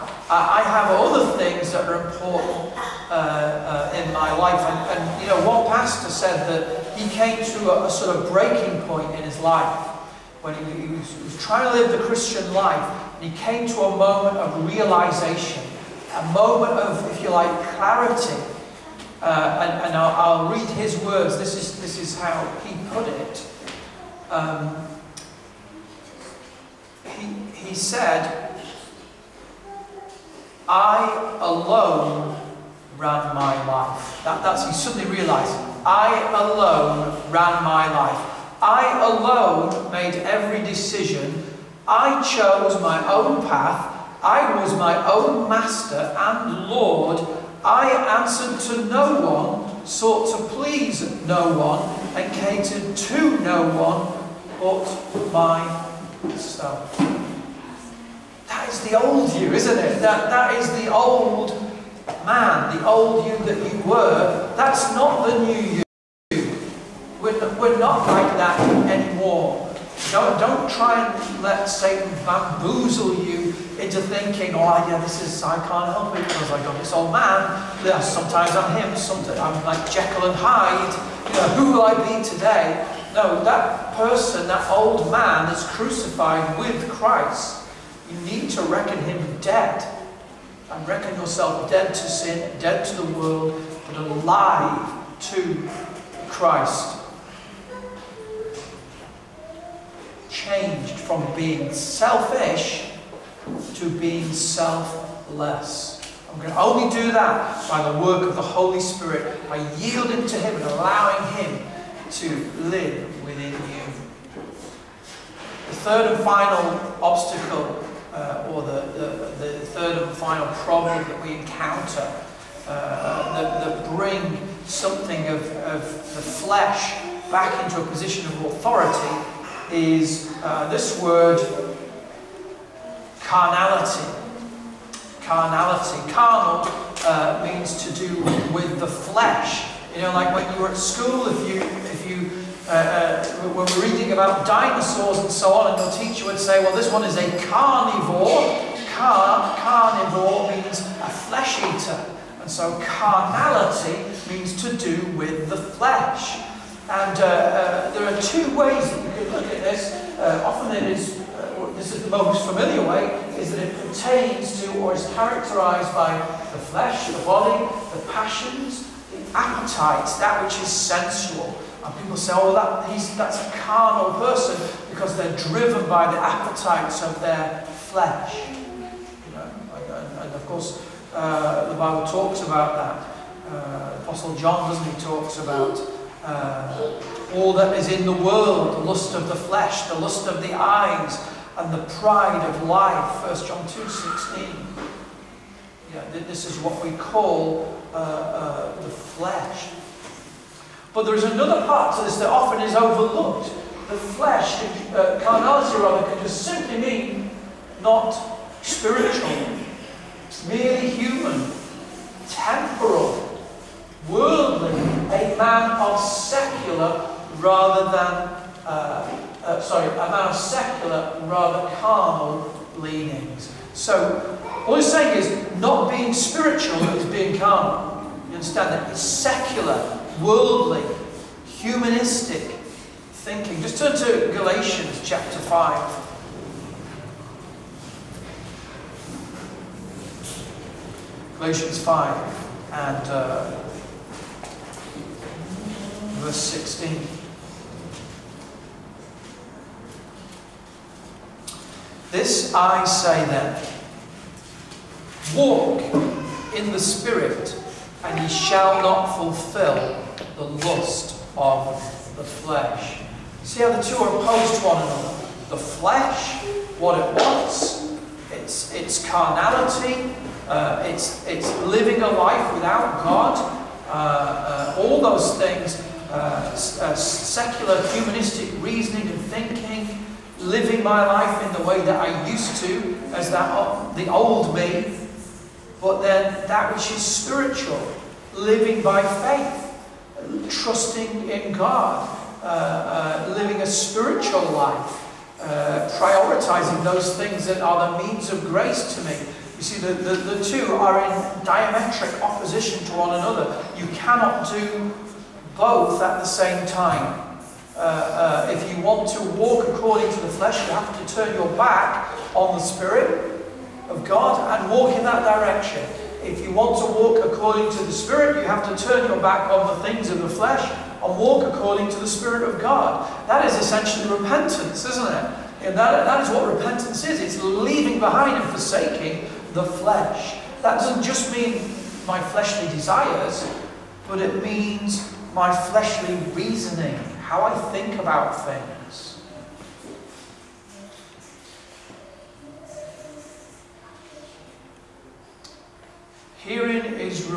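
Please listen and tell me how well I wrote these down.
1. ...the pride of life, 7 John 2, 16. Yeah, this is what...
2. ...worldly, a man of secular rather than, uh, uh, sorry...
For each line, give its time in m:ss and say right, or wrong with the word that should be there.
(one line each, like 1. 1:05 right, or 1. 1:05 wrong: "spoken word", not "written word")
1. 3:11 wrong: "1", not "7"
2. 3:34 right.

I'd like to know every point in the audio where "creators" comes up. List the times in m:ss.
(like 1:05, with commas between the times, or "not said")
not said.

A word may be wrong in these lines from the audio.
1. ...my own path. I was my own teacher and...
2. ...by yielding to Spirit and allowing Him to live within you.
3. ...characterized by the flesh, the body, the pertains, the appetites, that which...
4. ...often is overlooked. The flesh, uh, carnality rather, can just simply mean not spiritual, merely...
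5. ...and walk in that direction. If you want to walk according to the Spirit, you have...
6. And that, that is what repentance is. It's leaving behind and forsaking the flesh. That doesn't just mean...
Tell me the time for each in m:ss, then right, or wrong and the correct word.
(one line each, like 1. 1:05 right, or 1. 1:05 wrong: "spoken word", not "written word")
1. 0:42 wrong: "master", not "teacher"
2. 1:49 wrong: "Him", not "Spirit"
3. 2:45 wrong: "passions", not "pertains"
4. 3:22 right
5. 5:14 right
6. 5:25 right.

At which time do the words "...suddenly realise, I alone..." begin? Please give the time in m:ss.
0:34.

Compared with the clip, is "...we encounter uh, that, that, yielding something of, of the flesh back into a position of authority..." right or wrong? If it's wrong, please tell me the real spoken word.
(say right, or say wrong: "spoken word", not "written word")
wrong: "bring", not "yielding".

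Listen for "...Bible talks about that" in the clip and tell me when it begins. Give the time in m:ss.
3:01.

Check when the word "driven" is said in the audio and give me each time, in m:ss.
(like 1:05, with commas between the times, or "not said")
2:55.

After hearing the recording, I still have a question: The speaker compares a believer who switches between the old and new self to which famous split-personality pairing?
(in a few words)
Jekyll and Hyde.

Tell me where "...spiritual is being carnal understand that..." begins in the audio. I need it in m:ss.
3:46.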